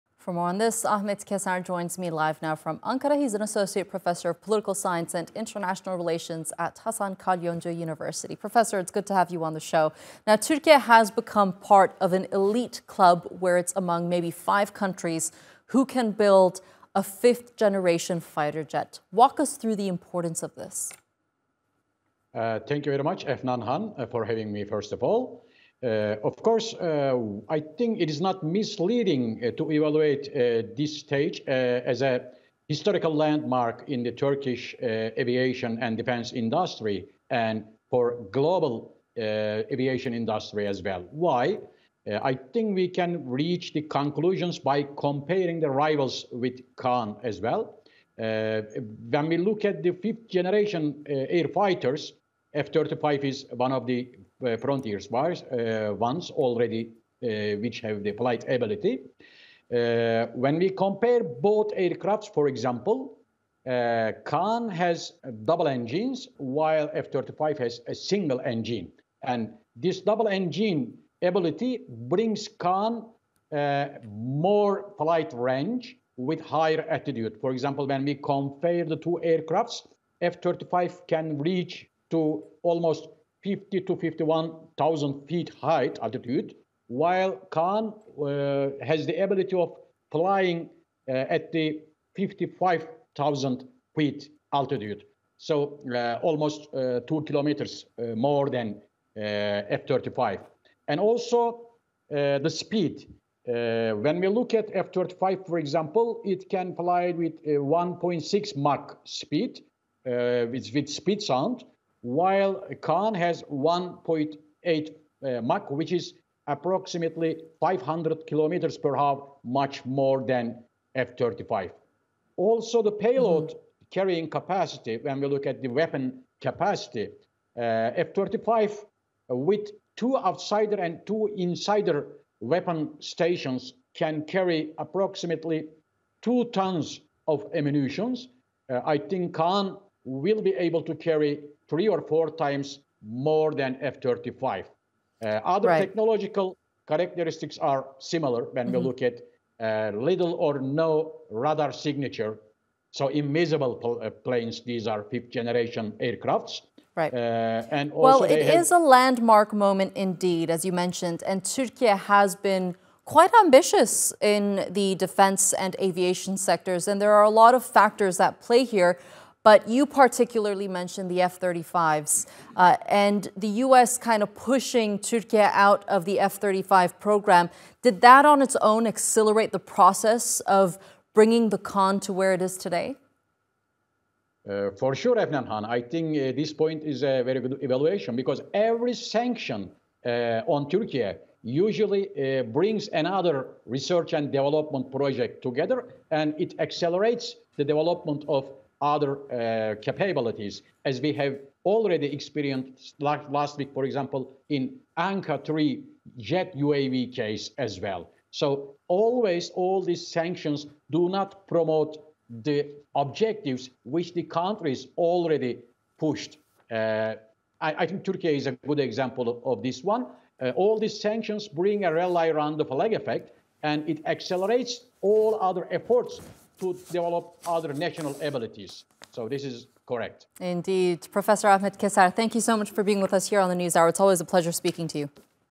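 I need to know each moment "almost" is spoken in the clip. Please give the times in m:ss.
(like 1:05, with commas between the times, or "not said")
1:22, 1:36.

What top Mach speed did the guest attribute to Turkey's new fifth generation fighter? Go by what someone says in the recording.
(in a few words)
1.8 Mach.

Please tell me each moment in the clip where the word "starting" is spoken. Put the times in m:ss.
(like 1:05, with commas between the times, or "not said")
not said.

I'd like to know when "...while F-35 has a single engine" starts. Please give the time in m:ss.
1:06.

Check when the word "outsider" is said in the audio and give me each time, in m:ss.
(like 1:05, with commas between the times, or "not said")
2:10.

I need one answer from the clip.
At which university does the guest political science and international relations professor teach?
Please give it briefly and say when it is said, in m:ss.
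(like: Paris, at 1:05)
Hasan Kalyoncu University, at 0:06.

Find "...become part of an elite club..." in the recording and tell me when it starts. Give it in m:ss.
0:11.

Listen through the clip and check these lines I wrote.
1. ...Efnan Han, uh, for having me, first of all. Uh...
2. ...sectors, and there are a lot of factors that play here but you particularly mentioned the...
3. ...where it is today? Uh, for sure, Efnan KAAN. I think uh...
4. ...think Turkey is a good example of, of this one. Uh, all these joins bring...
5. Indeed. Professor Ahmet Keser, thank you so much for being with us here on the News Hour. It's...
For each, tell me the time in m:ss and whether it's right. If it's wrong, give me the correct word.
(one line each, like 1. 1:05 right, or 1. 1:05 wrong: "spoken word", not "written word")
1. 0:23 right
2. 2:46 right
3. 3:02 wrong: "Han", not "KAAN"
4. 3:37 wrong: "sanctions", not "joins"
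5. 3:50 right.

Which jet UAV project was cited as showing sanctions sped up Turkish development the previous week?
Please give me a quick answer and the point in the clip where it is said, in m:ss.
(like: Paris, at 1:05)
Anka 3, at 3:24.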